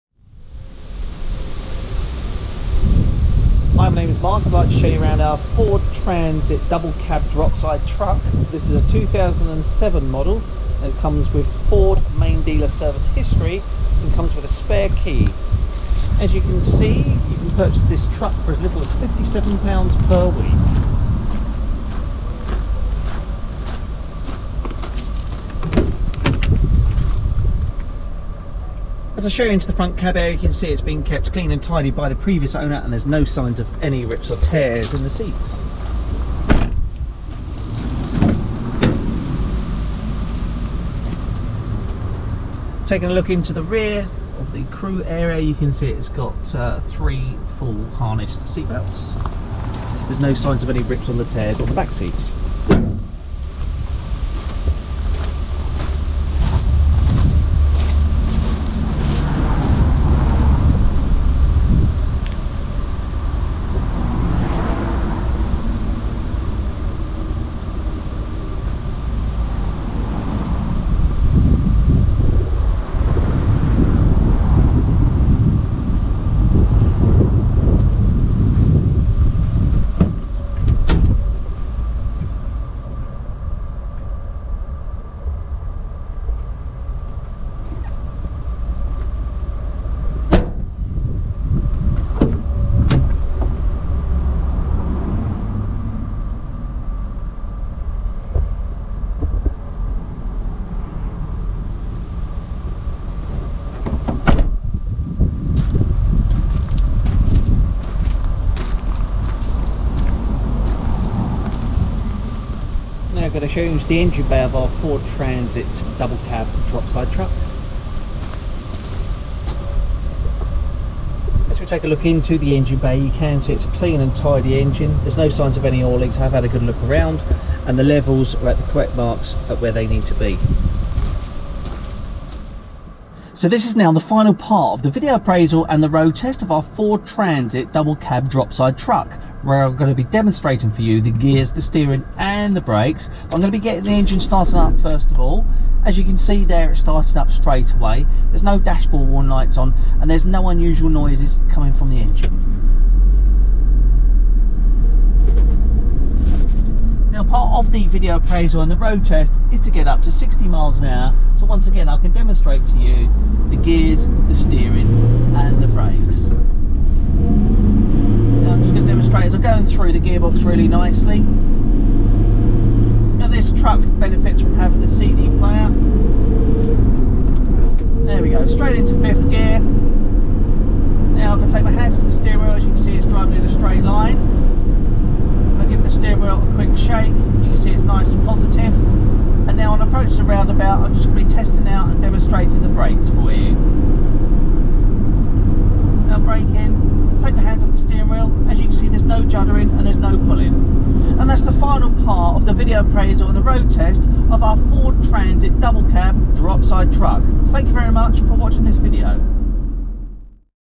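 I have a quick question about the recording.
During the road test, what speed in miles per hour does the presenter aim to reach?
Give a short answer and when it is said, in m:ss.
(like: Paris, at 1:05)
60, at 2:40.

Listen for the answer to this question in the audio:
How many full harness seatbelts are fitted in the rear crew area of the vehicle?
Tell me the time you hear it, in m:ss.
0:46.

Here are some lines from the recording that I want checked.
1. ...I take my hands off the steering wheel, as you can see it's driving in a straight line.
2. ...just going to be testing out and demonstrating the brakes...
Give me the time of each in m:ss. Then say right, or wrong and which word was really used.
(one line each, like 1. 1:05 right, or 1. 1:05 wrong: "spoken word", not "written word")
1. 3:01 right
2. 3:10 right.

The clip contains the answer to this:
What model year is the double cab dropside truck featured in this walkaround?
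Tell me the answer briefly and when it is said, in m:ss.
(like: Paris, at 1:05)
2007, at 0:08.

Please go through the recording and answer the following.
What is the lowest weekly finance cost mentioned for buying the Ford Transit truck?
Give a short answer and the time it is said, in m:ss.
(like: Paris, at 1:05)
£57, at 0:18.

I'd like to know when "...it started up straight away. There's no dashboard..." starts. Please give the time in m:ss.
2:26.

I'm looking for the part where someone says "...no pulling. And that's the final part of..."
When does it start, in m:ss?
3:19.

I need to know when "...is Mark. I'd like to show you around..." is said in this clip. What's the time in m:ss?
0:04.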